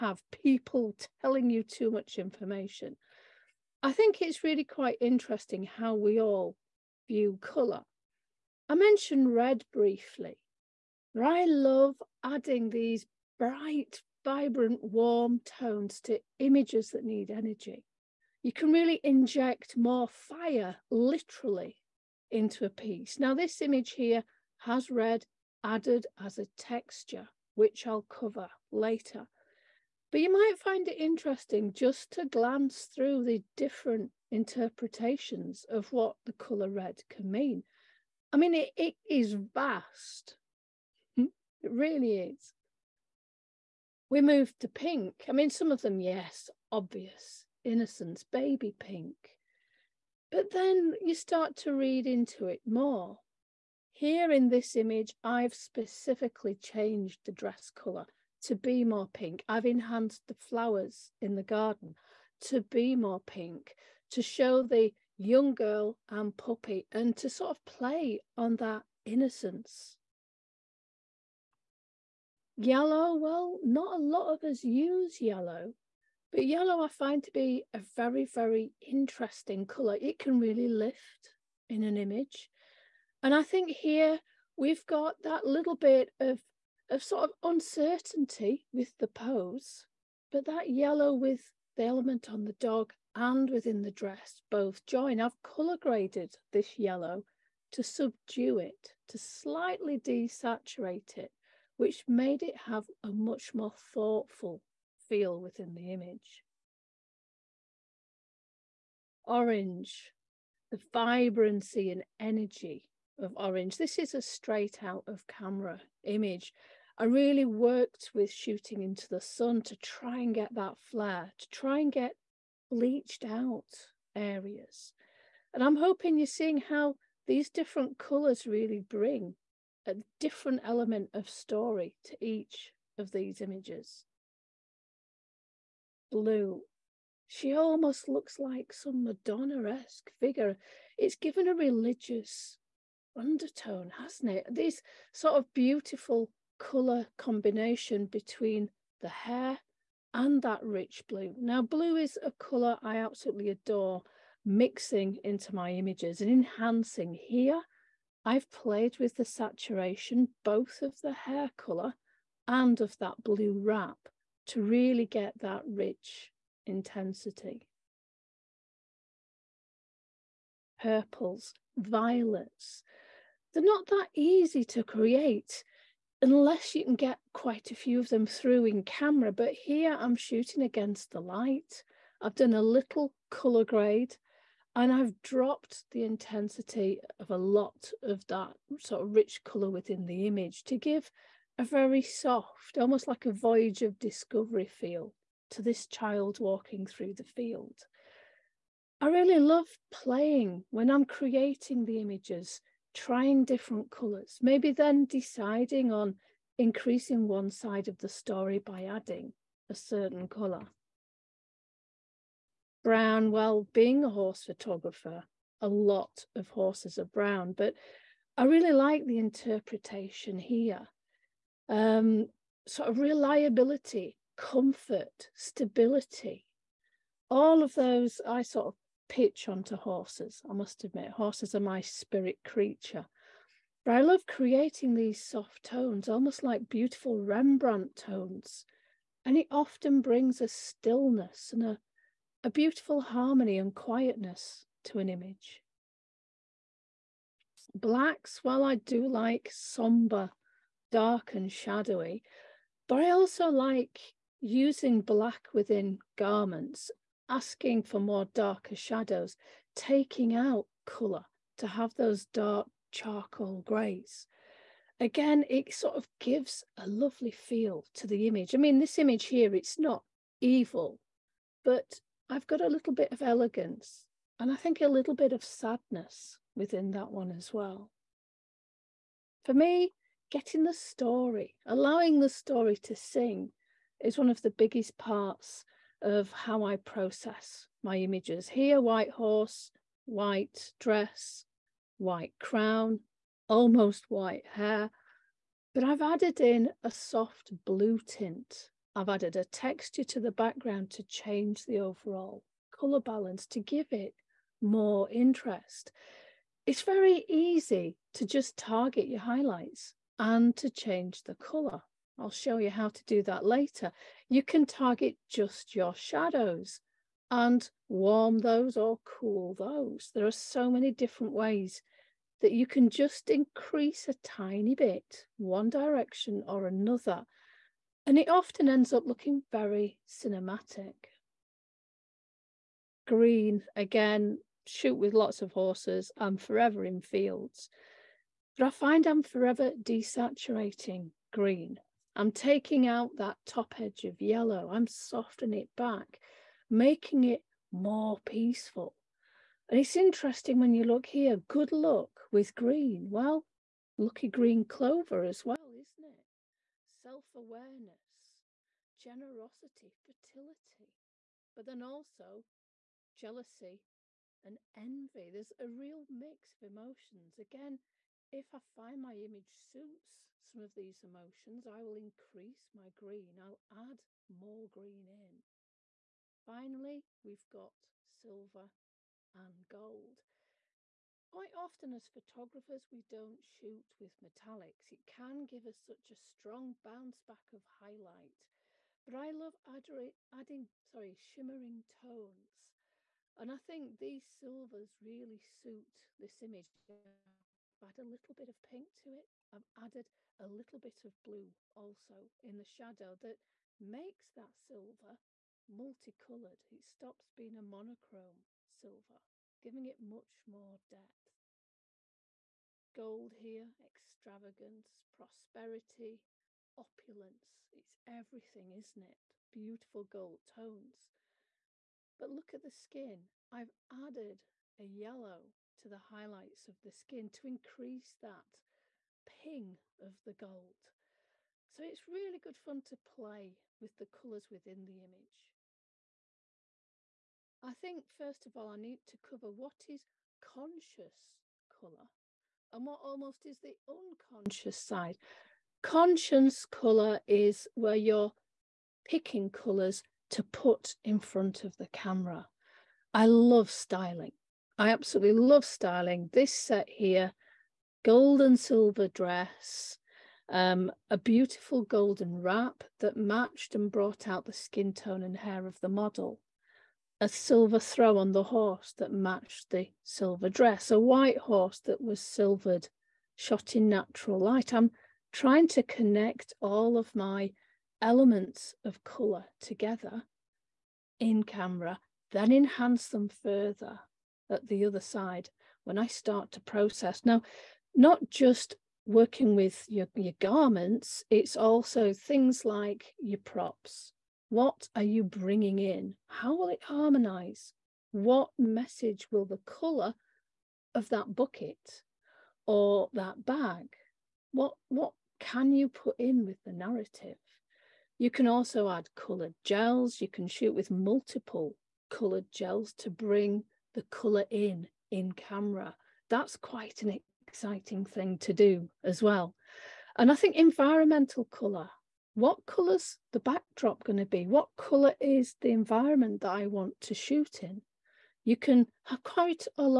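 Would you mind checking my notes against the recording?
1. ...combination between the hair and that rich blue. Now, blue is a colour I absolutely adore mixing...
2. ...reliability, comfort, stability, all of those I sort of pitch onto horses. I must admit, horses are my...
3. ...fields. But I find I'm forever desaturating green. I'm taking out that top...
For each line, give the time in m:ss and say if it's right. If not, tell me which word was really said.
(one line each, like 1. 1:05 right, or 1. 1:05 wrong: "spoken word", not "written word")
1. 2:27 right
2. 3:42 right
3. 5:37 right.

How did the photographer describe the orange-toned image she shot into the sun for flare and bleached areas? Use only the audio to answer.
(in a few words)
Straight out of camera.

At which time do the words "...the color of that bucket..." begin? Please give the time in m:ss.
8:19.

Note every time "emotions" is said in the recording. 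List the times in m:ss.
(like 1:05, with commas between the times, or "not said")
6:06, 6:11.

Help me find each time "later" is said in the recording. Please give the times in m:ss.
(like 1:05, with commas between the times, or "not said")
0:28, 5:13.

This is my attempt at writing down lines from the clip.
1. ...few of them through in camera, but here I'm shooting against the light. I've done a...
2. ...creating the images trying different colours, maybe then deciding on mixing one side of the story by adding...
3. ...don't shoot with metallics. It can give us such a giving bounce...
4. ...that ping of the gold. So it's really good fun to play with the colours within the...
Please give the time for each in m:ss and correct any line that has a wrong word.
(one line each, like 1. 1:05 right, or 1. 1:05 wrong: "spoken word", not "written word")
1. 2:57 right
2. 3:21 wrong: "increasing", not "mixing"
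3. 6:23 wrong: "strong", not "giving"
4. 7:08 right.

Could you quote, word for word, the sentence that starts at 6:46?
It stops being a monochrome silver, giving it much more depth.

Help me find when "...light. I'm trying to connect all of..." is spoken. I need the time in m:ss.
7:54.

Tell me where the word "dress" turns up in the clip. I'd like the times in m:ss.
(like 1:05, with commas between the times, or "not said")
0:57, 1:33, 4:50, 7:39, 7:50.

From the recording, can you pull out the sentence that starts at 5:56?
Self awareness, generosity, fertility, but then also jealousy and envy.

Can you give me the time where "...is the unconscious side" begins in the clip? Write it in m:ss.
7:23.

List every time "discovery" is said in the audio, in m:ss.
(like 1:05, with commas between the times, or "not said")
3:13.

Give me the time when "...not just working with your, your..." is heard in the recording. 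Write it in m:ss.
8:07.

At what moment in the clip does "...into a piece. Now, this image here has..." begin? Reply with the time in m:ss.
0:22.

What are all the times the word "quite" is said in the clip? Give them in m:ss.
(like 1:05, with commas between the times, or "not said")
0:04, 2:57, 6:21, 8:36, 8:49.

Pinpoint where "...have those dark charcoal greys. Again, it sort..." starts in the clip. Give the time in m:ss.
4:21.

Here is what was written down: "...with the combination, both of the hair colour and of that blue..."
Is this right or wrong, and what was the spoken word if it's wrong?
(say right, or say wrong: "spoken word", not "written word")
wrong: "saturation", not "combination".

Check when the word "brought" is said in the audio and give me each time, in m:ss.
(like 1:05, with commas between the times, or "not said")
7:43.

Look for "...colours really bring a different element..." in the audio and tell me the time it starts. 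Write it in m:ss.
2:07.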